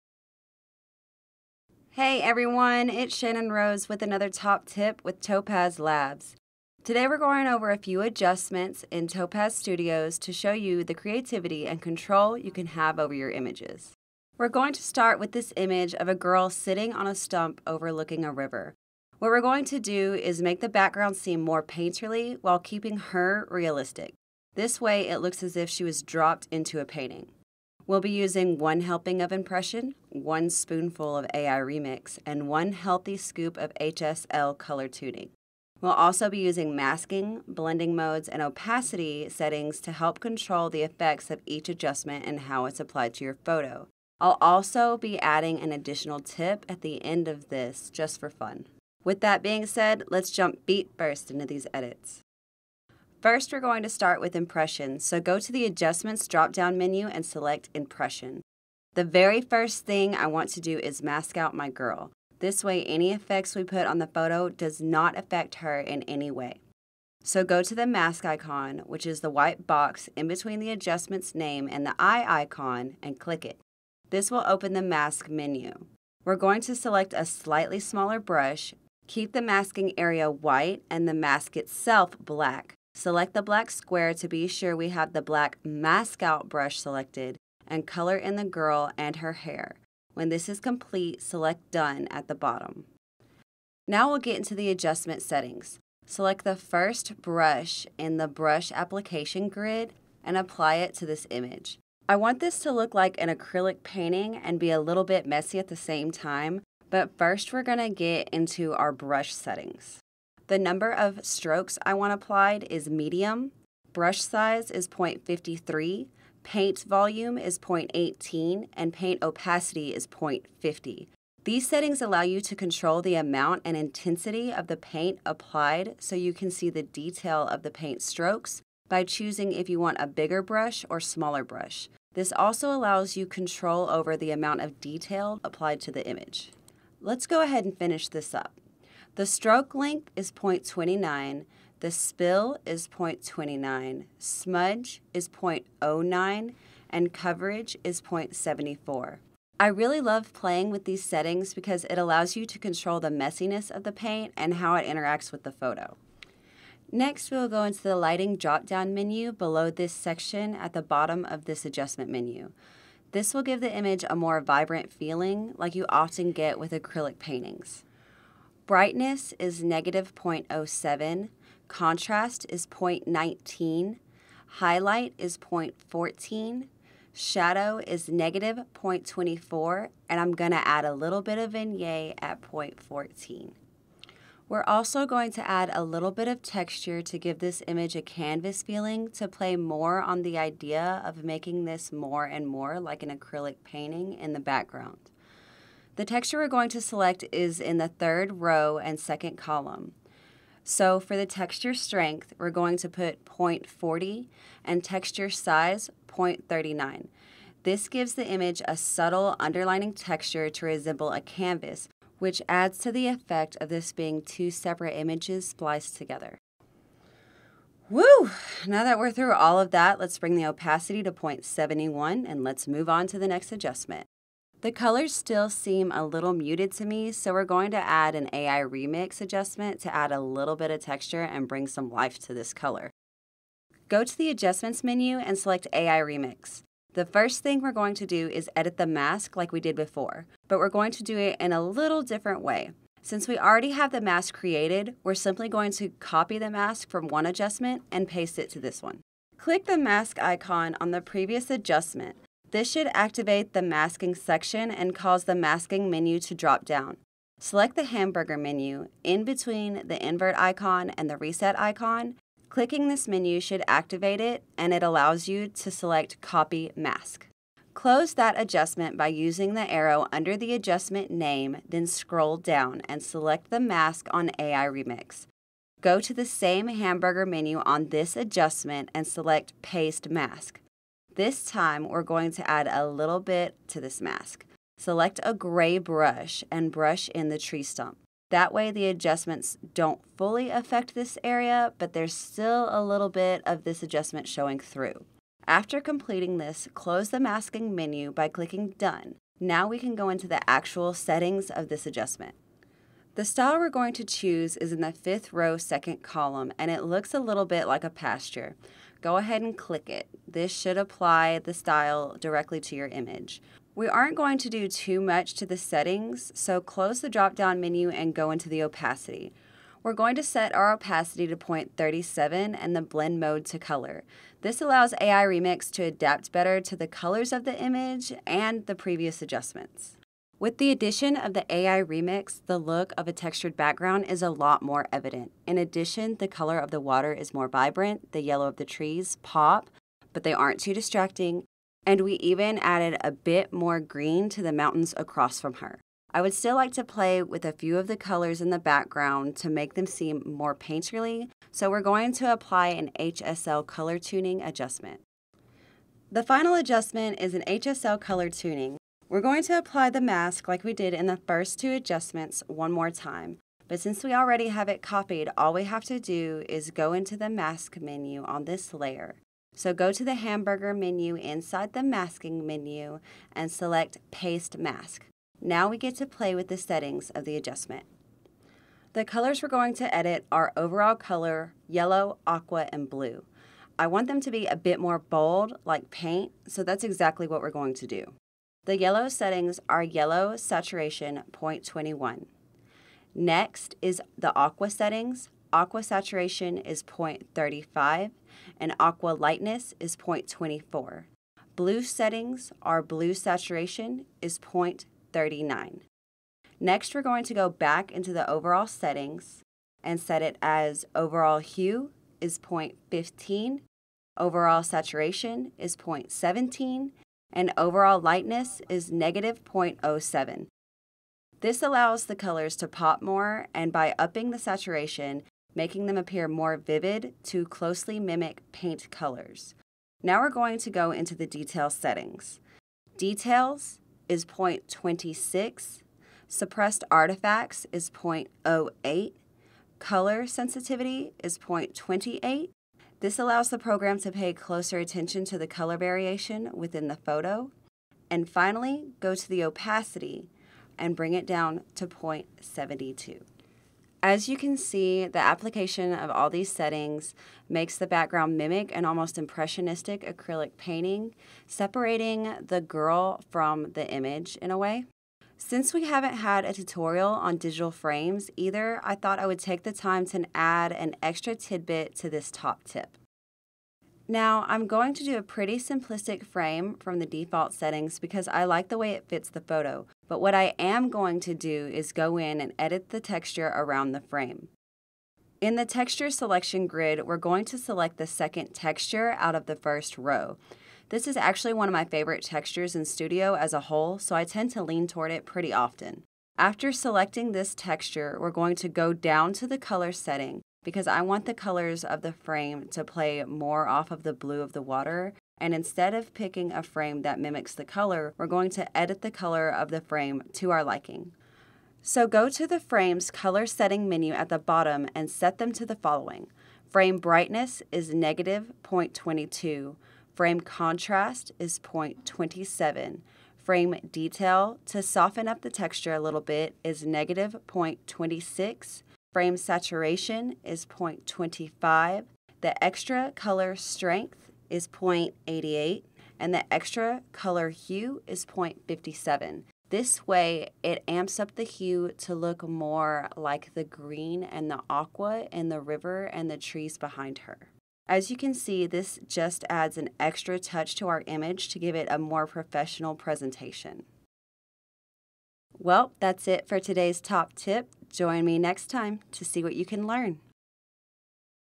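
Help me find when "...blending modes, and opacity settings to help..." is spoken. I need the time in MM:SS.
00:37.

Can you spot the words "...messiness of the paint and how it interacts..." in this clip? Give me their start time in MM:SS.
02:33.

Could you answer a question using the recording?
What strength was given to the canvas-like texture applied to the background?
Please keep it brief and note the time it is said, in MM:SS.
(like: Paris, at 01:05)
0.40, at 03:21.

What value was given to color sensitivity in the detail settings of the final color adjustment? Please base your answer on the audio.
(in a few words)
0.28.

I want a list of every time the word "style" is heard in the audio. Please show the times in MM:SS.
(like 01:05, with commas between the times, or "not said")
05:03, 05:11.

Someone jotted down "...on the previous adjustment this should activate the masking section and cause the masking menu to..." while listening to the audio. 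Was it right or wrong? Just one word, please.
right.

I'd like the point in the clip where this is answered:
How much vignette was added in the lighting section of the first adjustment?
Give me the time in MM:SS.
03:01.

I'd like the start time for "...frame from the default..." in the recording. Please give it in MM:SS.
07:56.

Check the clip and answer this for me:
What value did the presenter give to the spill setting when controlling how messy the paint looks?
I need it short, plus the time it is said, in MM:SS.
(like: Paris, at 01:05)
0.29, at 02:21.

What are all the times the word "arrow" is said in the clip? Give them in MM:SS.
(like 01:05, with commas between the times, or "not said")
04:29.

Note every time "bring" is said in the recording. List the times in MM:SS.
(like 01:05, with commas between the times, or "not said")
03:40, 03:51, 07:30.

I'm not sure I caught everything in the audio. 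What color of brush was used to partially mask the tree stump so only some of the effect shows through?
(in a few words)
Gray.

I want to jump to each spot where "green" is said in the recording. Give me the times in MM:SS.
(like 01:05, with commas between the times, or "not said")
05:43, 09:03.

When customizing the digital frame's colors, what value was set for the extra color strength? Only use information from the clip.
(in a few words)
0.88.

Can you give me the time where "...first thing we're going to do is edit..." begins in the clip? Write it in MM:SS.
03:57.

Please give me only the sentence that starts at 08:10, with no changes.
This is actually one of my favorite textures in Studio as a whole, so I tend to lean toward it pretty often.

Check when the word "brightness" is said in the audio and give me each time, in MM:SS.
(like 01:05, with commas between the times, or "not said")
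02:48, 08:36.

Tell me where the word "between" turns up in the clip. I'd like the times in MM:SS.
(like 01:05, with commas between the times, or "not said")
01:10, 04:19.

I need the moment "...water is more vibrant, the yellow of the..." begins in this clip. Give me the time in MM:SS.
05:36.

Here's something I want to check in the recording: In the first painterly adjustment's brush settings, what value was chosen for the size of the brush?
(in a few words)
0.53.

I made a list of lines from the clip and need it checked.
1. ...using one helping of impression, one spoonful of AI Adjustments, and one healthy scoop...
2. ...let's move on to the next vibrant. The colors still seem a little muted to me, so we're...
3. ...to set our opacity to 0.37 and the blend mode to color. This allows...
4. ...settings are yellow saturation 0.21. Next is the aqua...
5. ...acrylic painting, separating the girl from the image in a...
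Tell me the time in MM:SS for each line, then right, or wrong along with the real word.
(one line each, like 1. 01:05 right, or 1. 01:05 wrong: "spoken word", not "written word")
1. 00:28 wrong: "Remix", not "Adjustments"
2. 03:42 wrong: "adjustment", not "vibrant"
3. 05:20 right
4. 06:29 right
5. 07:40 right.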